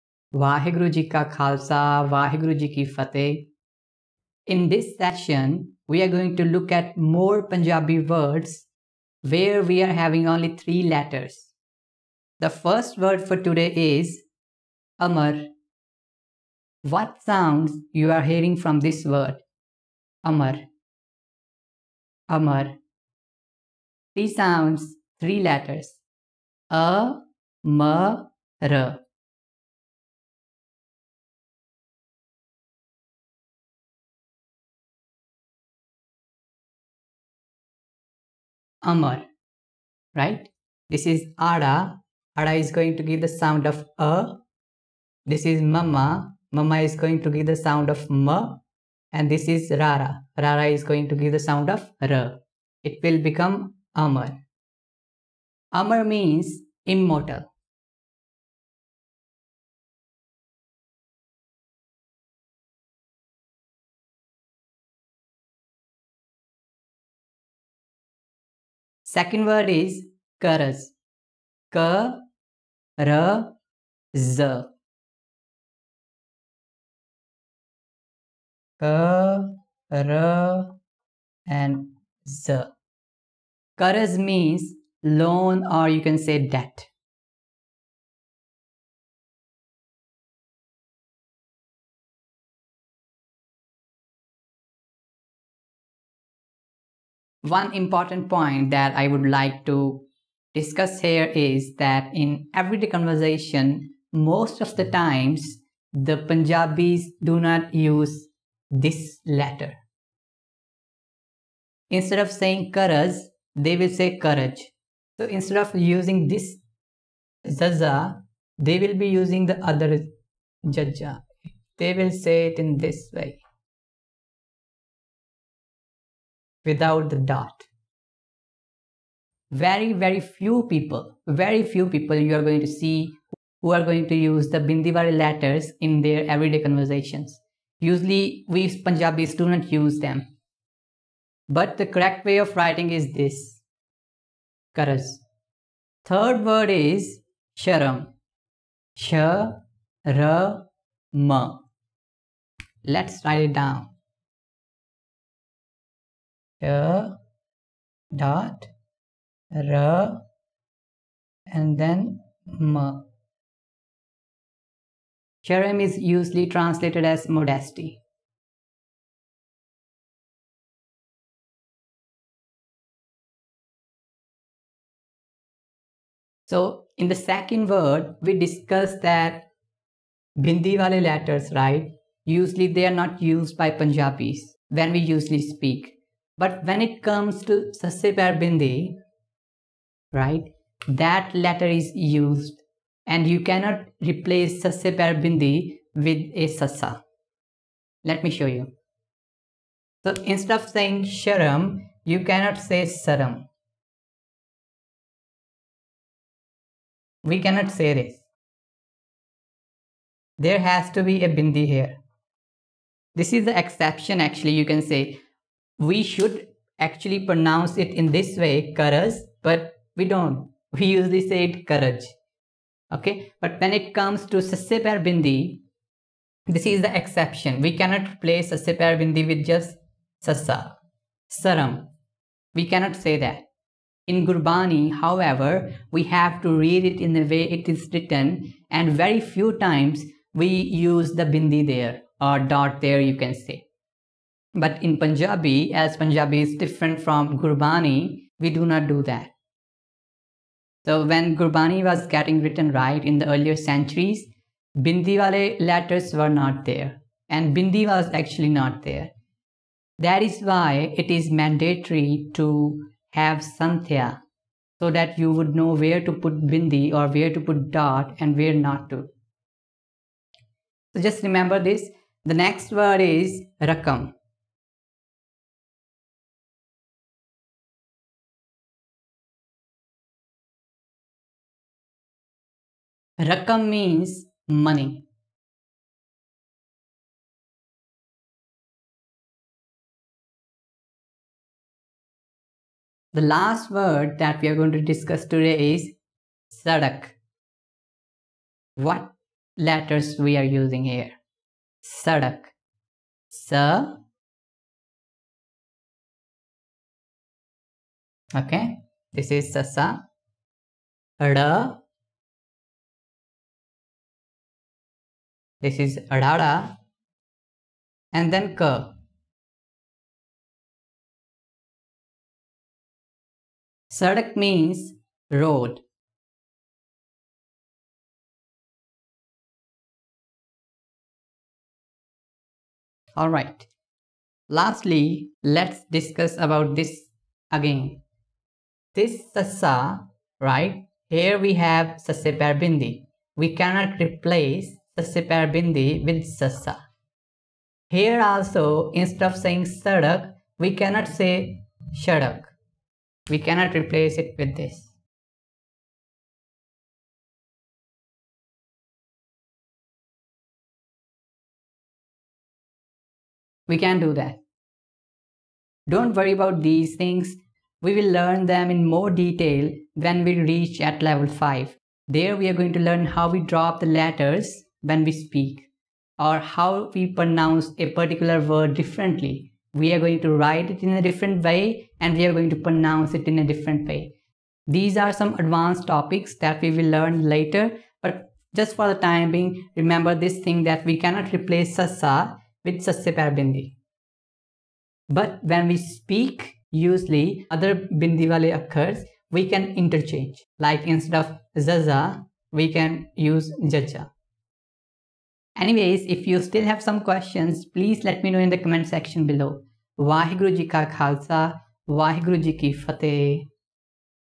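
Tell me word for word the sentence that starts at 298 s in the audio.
What letters we are using here?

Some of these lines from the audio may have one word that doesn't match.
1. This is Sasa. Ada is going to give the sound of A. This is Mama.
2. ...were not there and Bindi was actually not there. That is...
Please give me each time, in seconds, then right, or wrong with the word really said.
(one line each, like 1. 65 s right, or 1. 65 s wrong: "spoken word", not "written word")
1. 40 s wrong: "Ada", not "Sasa"
2. 256 s right.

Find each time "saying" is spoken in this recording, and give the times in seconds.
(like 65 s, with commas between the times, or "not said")
112 s, 200 s, 349 s.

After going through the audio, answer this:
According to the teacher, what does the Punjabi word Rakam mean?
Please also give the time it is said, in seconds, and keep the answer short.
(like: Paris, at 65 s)
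Money, at 284 s.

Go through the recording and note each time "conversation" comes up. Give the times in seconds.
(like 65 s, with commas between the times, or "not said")
102 s, 136 s.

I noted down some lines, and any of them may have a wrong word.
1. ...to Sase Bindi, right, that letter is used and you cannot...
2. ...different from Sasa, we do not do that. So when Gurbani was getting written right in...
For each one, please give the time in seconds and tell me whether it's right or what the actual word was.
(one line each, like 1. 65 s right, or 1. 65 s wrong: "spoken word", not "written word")
1. 187 s right
2. 246 s wrong: "Gurbani", not "Sasa".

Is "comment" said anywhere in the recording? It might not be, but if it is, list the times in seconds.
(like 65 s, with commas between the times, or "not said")
408 s.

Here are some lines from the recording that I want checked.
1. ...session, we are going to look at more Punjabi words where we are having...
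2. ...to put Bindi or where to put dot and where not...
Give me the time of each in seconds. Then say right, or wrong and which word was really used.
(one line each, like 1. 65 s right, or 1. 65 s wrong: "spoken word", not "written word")
1. 4 s right
2. 266 s right.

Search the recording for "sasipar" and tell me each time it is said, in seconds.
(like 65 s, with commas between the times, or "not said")
224 s, 228 s, 344 s.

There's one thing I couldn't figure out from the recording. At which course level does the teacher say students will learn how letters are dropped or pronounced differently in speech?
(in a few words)
Level 5.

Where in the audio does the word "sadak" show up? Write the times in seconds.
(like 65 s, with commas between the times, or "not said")
296 s, 301 s, 323 s, 349 s.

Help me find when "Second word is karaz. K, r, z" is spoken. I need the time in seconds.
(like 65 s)
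69 s.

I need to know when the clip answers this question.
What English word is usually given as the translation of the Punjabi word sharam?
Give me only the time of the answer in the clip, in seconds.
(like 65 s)
167 s.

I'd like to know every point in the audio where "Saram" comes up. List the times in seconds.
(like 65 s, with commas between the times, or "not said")
202 s, 231 s.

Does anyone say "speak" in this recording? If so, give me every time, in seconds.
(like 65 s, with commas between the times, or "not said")
185 s, 375 s, 395 s.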